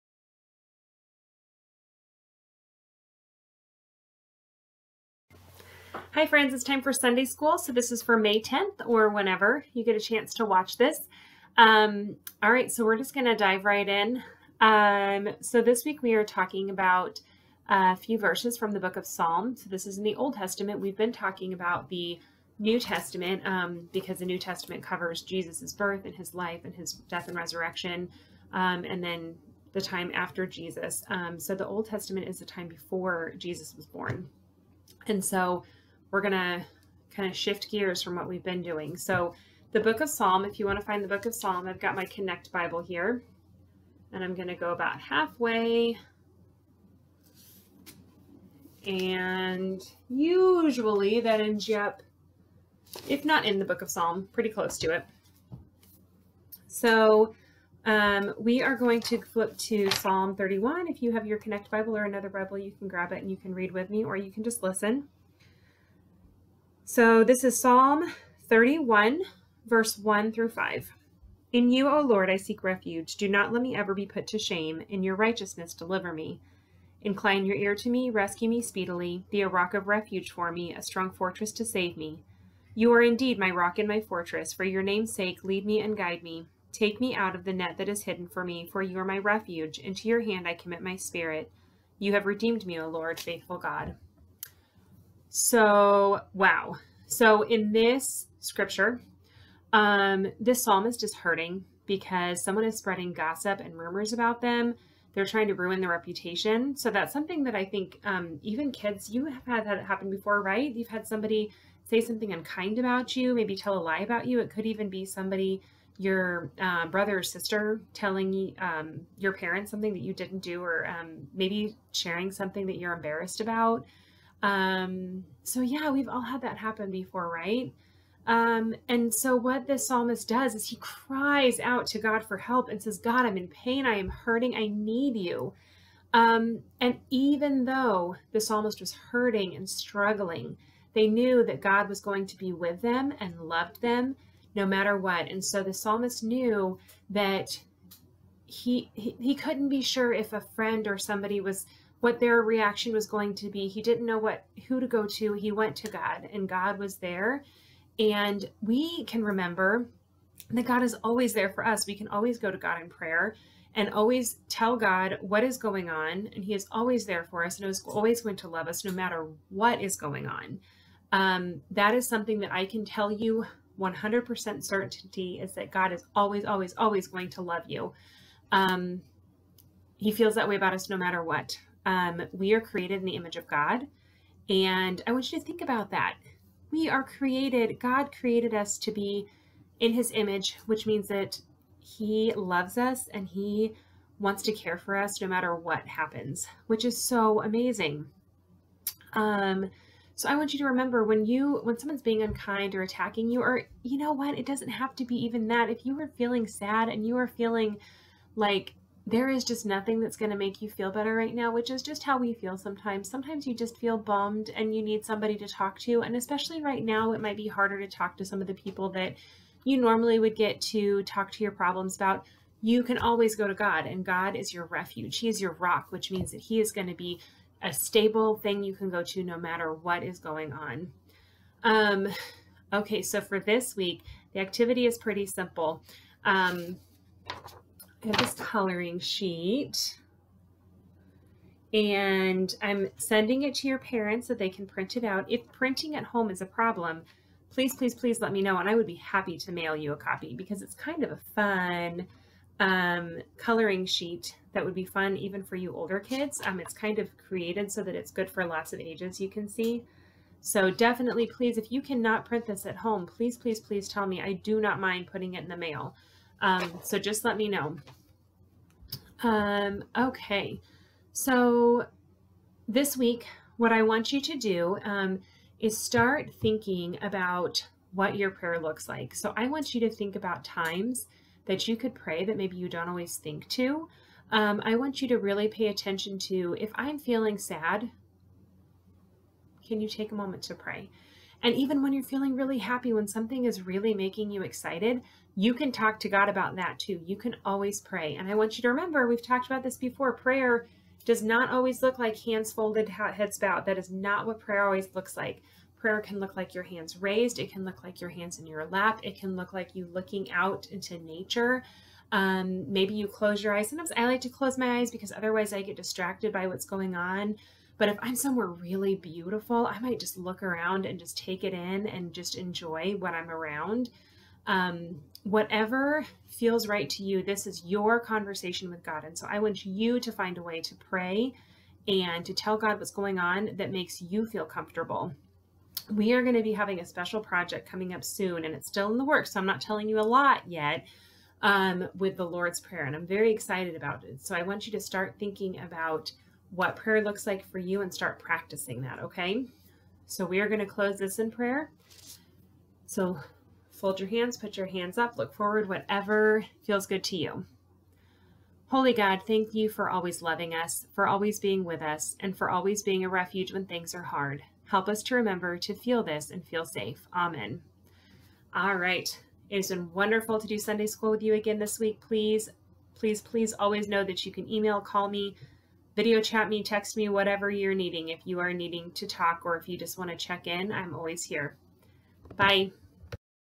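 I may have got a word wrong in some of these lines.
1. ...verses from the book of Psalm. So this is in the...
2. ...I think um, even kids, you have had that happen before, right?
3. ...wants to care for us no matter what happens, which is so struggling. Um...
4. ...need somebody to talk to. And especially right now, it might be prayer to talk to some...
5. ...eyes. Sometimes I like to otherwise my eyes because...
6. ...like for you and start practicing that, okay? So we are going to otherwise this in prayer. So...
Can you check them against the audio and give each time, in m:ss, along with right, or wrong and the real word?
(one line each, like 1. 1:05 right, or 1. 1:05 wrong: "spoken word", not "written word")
1. 0:18 right
2. 1:47 right
3. 3:14 wrong: "amazing", not "struggling"
4. 3:34 wrong: "harder", not "prayer"
5. 5:13 wrong: "close", not "otherwise"
6. 5:47 wrong: "close", not "otherwise".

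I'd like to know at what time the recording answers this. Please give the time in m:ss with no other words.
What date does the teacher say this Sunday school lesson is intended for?
0:08.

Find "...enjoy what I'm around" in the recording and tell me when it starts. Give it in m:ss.
5:22.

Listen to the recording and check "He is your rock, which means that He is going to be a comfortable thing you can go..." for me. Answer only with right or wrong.
wrong.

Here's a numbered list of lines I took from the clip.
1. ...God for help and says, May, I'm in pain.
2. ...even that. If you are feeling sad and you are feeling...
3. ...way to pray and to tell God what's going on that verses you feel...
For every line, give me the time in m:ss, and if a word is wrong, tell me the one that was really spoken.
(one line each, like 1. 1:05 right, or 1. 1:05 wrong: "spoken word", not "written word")
1. 2:11 wrong: "God", not "May"
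2. 3:25 right
3. 5:30 wrong: "makes", not "verses".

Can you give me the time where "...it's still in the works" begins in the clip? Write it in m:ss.
5:38.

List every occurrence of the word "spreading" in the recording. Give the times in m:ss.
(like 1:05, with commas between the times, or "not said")
1:42.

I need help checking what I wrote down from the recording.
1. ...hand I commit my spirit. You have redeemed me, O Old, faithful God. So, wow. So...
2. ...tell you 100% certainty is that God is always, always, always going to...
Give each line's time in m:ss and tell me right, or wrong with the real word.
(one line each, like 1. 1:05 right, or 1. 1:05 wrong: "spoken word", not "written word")
1. 1:30 wrong: "Lord", not "Old"
2. 2:52 right.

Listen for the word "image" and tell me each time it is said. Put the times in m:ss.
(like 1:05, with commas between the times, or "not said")
3:03, 3:10.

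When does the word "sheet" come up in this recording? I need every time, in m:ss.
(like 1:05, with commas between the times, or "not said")
3:58, 4:13.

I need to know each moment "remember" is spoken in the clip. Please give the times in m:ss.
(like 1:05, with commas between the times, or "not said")
2:39, 3:20, 4:58, 6:05.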